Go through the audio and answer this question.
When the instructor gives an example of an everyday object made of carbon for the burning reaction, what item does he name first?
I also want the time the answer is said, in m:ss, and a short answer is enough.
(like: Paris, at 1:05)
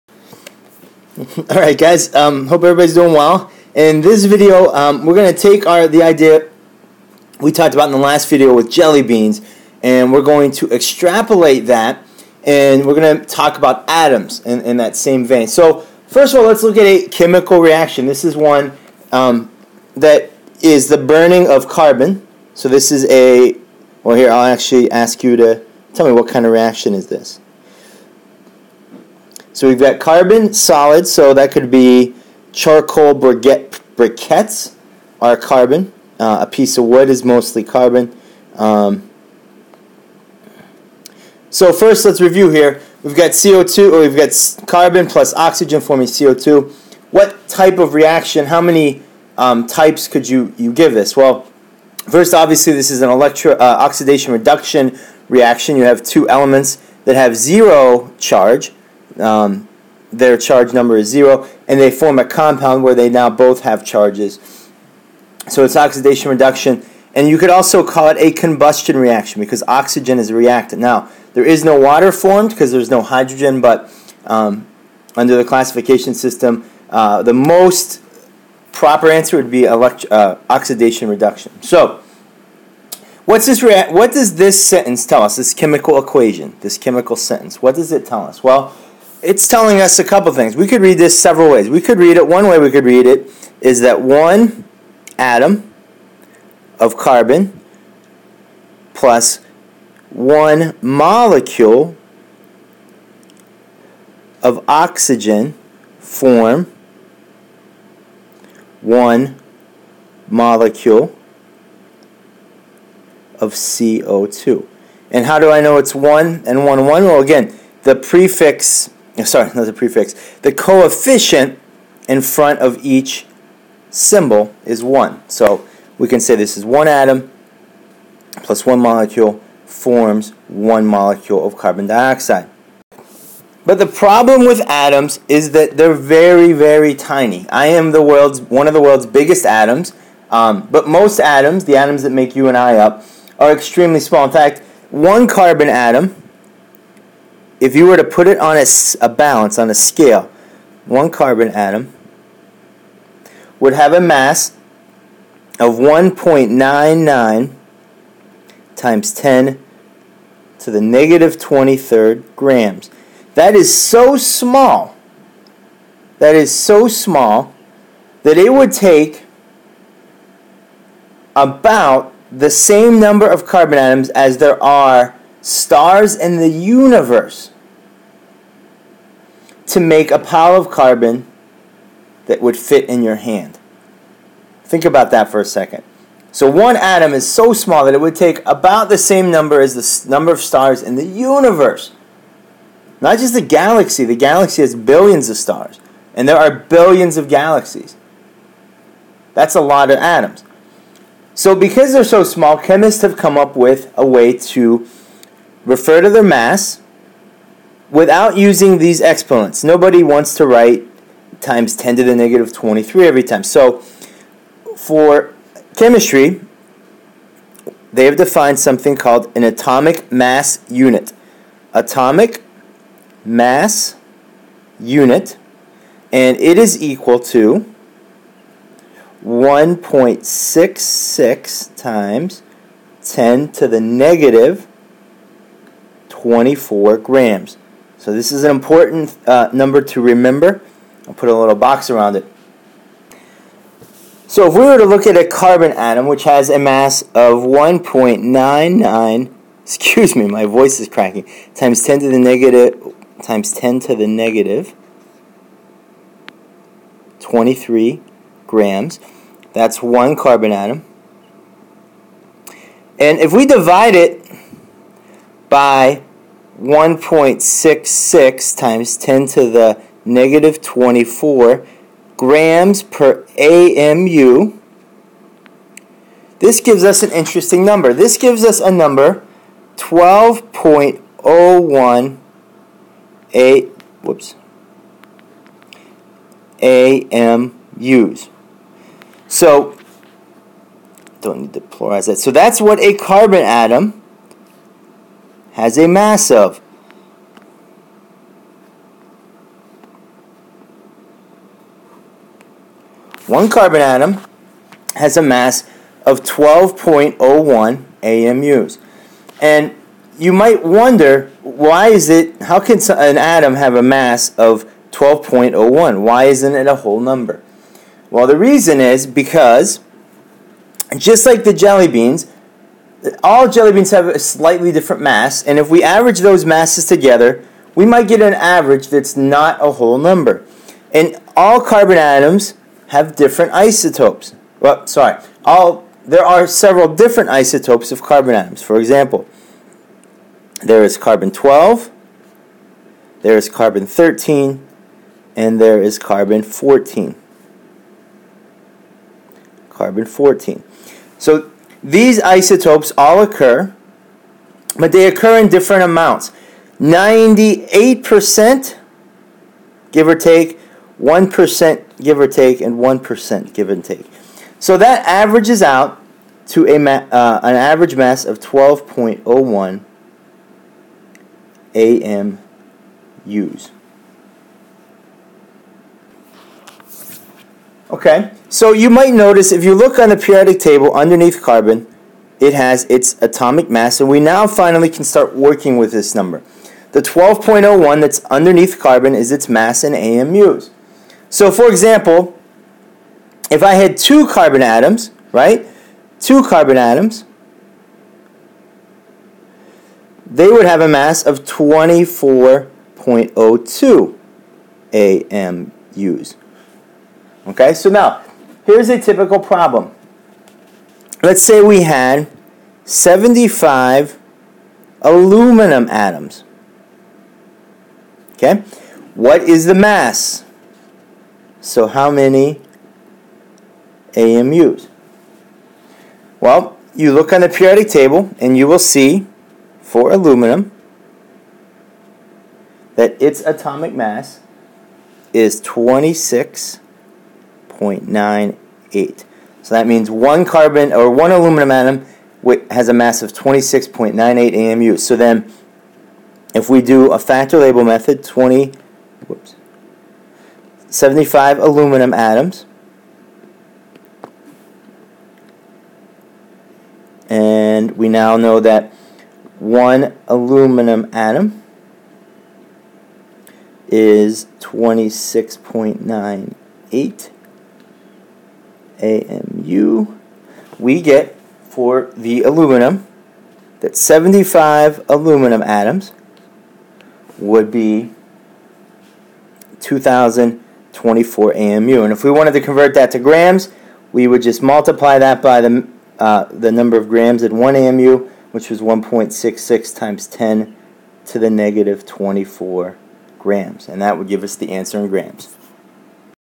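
charcoal briquette, at 0:32.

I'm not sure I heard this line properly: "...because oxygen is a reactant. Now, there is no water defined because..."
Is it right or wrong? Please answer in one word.
wrong.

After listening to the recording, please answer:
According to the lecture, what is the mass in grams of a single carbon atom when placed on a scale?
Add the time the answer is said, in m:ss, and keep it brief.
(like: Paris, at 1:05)
1.99 times 10 to the -23 grams, at 2:35.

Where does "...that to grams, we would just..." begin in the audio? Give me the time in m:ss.
8:02.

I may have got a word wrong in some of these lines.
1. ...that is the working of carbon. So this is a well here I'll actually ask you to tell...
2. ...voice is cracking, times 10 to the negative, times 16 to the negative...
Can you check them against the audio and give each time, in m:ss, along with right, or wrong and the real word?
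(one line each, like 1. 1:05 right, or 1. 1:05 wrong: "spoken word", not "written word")
1. 0:19 wrong: "burning", not "working"
2. 4:10 wrong: "10", not "16".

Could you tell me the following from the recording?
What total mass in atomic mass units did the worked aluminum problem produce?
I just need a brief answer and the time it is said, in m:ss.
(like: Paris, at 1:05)
2024 AMU, at 7:59.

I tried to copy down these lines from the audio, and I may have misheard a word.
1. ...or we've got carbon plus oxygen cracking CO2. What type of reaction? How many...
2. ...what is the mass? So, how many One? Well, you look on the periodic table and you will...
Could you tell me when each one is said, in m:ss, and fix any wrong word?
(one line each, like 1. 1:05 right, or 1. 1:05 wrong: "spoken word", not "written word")
1. 0:43 wrong: "forming", not "cracking"
2. 6:59 wrong: "AMUs", not "One".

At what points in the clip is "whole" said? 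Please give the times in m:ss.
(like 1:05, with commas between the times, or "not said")
5:16, 5:29.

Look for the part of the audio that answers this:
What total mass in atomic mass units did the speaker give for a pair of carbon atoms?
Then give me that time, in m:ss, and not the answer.
6:41.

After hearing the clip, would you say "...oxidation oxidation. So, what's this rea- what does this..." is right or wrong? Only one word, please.
wrong.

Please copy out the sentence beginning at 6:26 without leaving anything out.
The 12.01 that's underneath carbon is its mass in AMUs.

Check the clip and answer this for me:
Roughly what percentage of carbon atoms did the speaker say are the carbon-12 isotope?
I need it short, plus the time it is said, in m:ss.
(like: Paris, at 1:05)
98%, at 5:56.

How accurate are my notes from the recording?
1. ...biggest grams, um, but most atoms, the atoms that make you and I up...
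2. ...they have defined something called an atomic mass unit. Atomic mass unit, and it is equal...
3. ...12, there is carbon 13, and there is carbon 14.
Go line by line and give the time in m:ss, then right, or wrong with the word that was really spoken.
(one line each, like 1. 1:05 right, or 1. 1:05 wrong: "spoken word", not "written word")
1. 2:19 wrong: "atoms", not "grams"
2. 3:37 right
3. 5:41 right.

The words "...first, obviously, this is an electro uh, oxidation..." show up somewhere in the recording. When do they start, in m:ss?
0:52.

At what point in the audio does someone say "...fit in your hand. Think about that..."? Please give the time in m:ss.
3:02.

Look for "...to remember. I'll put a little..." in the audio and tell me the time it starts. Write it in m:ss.
3:59.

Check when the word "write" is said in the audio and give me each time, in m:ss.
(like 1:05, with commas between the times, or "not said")
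3:30.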